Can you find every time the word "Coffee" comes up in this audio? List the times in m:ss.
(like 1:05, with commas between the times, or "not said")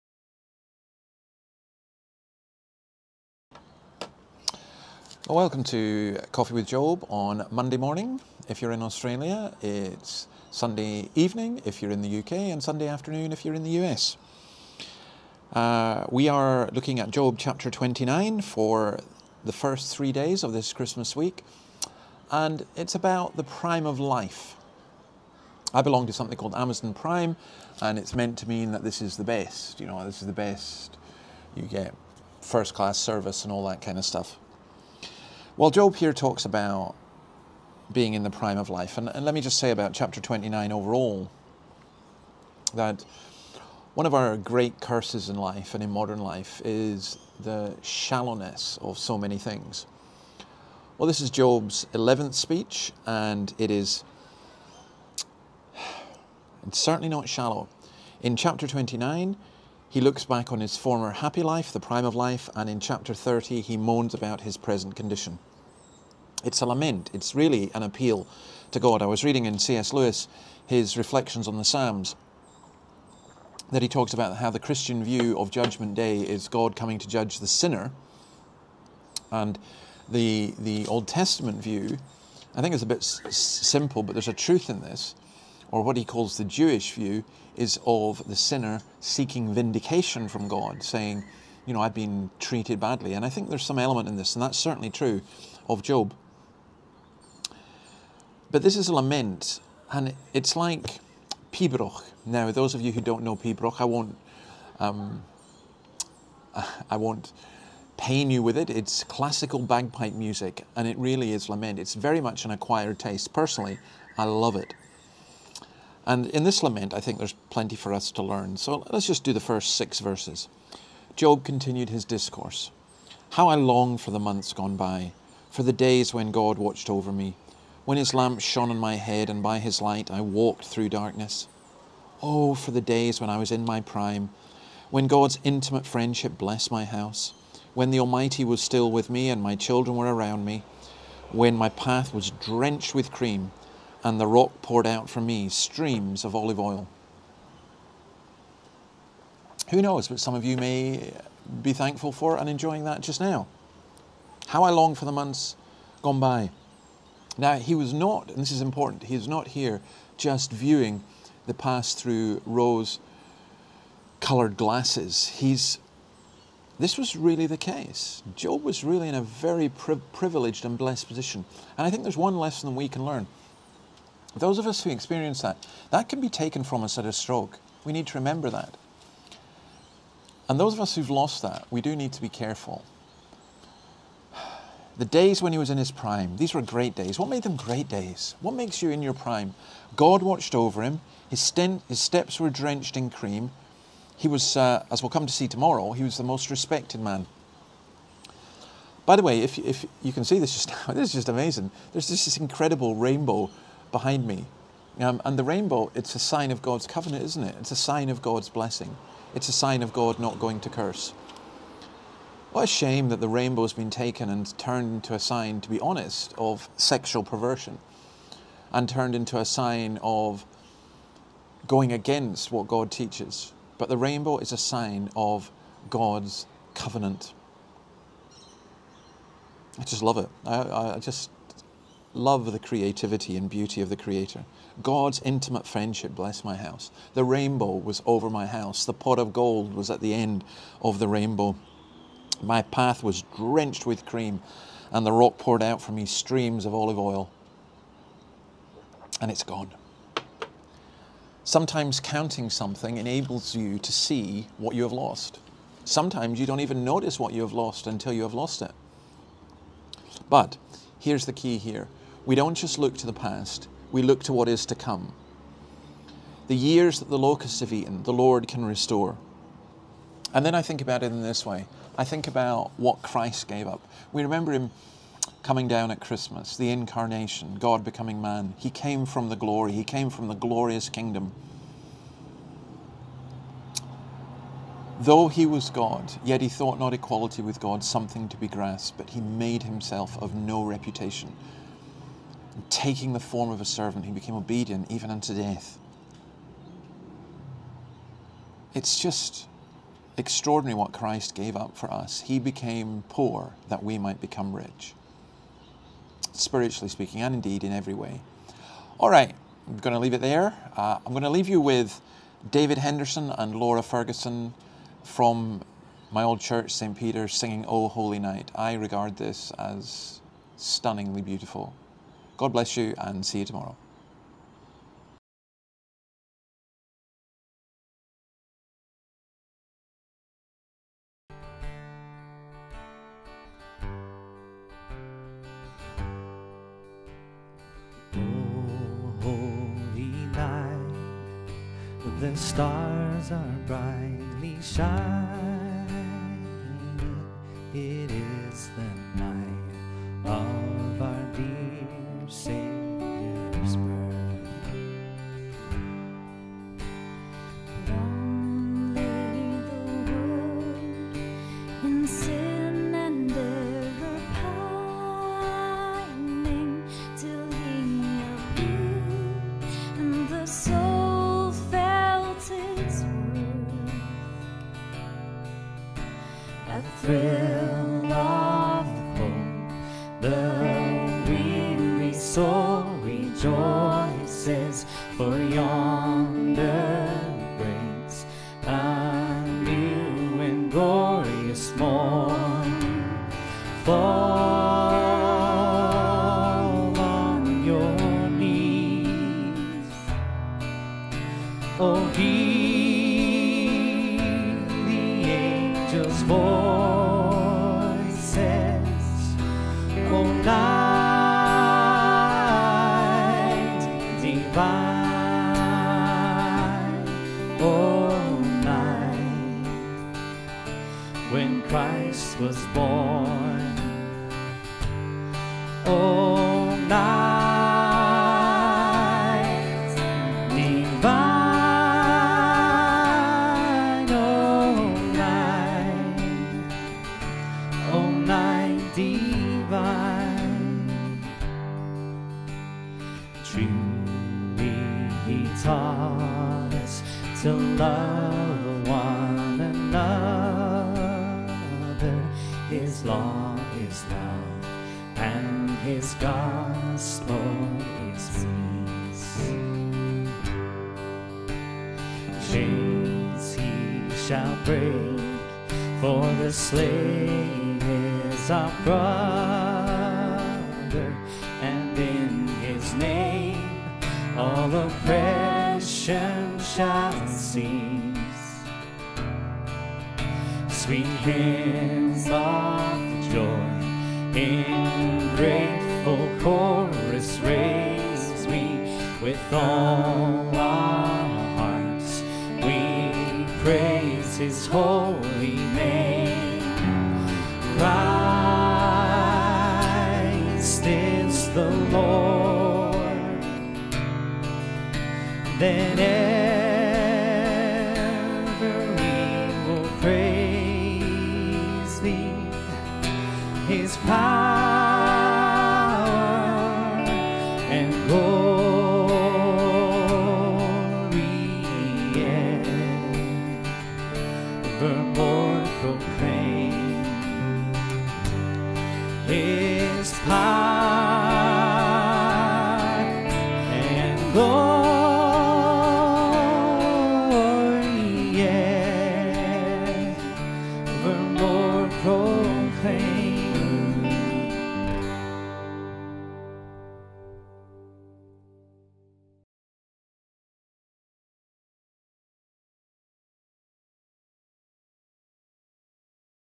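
0:06.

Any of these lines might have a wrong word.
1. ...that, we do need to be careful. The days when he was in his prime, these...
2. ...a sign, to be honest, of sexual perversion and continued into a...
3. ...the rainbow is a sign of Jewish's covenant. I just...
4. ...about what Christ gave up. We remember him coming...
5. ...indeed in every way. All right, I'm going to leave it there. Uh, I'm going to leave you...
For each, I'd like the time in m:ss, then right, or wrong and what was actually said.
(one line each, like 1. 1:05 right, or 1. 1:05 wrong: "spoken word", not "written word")
1. 3:01 right
2. 3:35 wrong: "turned", not "continued"
3. 3:43 wrong: "God", not "Jewish"
4. 4:32 right
5. 5:07 right.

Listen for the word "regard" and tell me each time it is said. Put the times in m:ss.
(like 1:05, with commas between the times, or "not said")
5:18.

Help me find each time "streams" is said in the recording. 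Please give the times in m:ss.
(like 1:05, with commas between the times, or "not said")
2:25, 4:06.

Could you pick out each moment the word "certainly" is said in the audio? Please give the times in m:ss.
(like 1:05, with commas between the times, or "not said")
0:56, 1:34.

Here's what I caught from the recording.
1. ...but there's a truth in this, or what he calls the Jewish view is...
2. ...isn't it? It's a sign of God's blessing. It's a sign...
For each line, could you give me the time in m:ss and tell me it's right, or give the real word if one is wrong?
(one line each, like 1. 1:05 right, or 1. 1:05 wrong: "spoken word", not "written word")
1. 1:24 right
2. 3:27 right.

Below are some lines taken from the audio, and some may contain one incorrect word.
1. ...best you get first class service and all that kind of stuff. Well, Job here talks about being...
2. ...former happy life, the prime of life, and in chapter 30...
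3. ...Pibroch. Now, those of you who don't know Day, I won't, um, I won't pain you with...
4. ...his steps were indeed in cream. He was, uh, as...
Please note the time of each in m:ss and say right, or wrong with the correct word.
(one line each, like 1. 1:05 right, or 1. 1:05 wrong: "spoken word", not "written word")
1. 0:30 right
2. 1:00 right
3. 1:41 wrong: "Pibroch", not "Day"
4. 3:11 wrong: "drenched", not "indeed".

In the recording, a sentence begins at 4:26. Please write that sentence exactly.
The years that the locusts have eaten, the Lord can restore.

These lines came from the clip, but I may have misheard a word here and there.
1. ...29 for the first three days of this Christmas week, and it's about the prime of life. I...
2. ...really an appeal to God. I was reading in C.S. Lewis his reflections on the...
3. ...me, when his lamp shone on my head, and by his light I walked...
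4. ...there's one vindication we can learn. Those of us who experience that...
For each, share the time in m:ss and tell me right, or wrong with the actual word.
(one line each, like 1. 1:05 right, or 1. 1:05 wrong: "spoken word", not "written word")
1. 0:17 right
2. 1:07 right
3. 2:07 right
4. 2:52 wrong: "lesson", not "vindication".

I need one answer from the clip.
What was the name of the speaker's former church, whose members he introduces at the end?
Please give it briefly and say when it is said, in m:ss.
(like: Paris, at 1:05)
St. Peter's, at 5:16.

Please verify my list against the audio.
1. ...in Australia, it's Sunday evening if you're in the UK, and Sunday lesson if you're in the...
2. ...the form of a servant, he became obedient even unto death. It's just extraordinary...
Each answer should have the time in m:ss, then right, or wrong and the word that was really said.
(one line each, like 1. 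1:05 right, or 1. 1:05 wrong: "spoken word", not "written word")
1. 0:08 wrong: "afternoon", not "lesson"
2. 4:53 right.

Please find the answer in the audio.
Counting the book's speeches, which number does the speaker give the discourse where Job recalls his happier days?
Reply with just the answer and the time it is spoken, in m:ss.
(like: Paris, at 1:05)
11th, at 0:51.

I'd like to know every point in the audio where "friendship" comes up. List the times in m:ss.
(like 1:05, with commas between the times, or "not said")
2:15, 3:55.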